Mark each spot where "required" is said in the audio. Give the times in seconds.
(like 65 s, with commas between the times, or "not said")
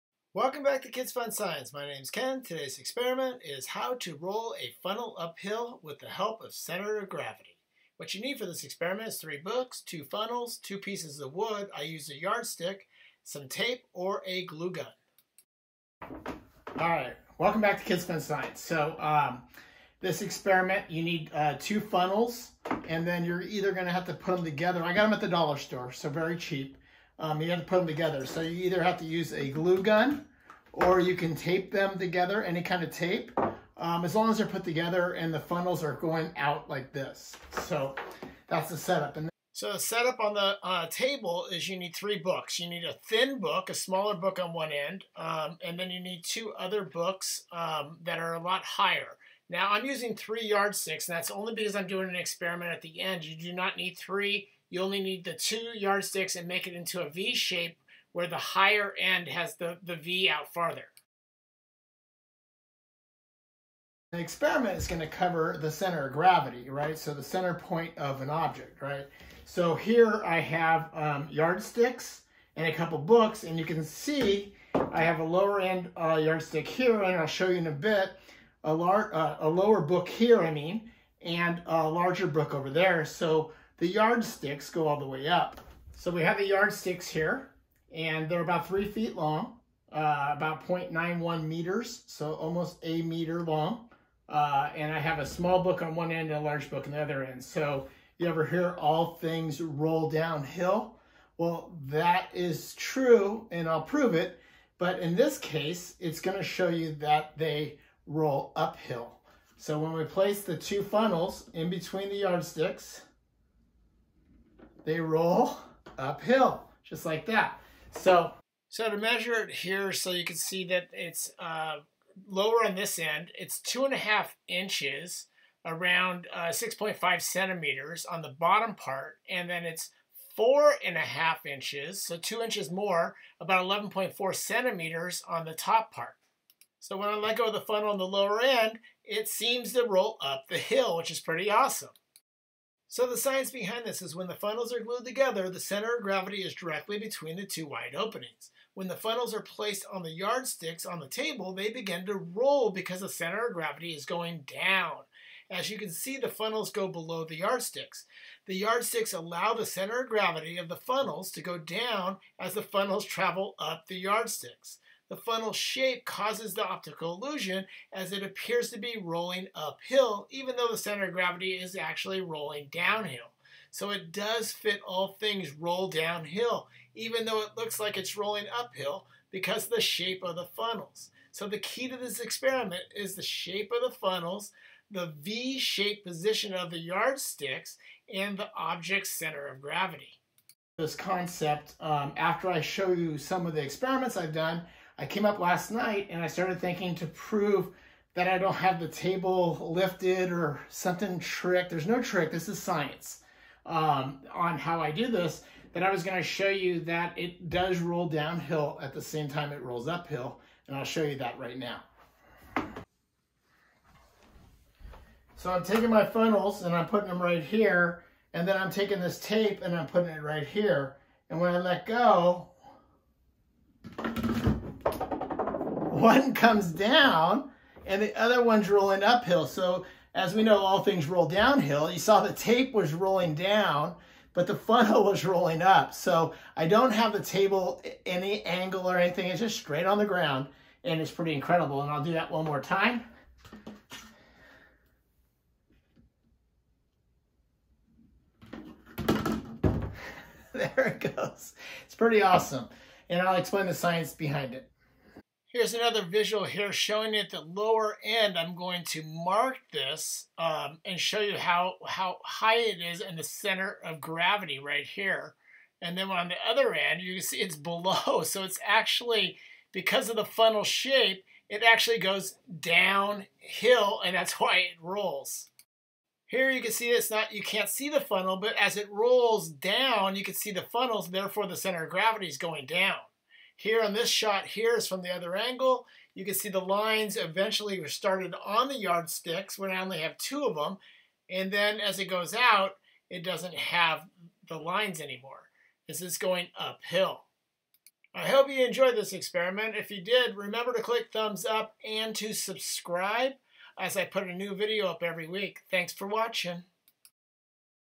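not said.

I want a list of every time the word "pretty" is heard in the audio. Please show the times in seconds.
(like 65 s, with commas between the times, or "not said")
141 s, 241 s, 251 s.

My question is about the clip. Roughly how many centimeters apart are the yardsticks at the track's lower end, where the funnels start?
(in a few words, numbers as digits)
6.5 centimeters.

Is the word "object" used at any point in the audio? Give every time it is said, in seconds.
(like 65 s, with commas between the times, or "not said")
68 s, 188 s.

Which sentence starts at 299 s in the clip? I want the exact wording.
If you did, remember to click thumbs up and to subscribe as I put a new video up every week.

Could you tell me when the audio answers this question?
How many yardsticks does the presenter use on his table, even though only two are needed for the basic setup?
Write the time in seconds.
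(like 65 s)
50 s.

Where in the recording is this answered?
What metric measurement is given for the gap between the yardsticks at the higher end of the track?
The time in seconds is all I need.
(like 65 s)
133 s.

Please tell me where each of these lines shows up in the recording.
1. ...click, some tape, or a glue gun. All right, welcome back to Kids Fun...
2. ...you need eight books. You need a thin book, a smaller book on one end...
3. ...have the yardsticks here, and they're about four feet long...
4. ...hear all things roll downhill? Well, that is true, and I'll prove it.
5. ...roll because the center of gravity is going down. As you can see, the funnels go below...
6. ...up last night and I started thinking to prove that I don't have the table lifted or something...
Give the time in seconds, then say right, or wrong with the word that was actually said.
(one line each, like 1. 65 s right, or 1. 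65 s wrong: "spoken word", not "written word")
1. 12 s wrong: "yardstick", not "click"
2. 41 s wrong: "three", not "eight"
3. 86 s wrong: "three", not "four"
4. 98 s right
5. 152 s right
6. 195 s right.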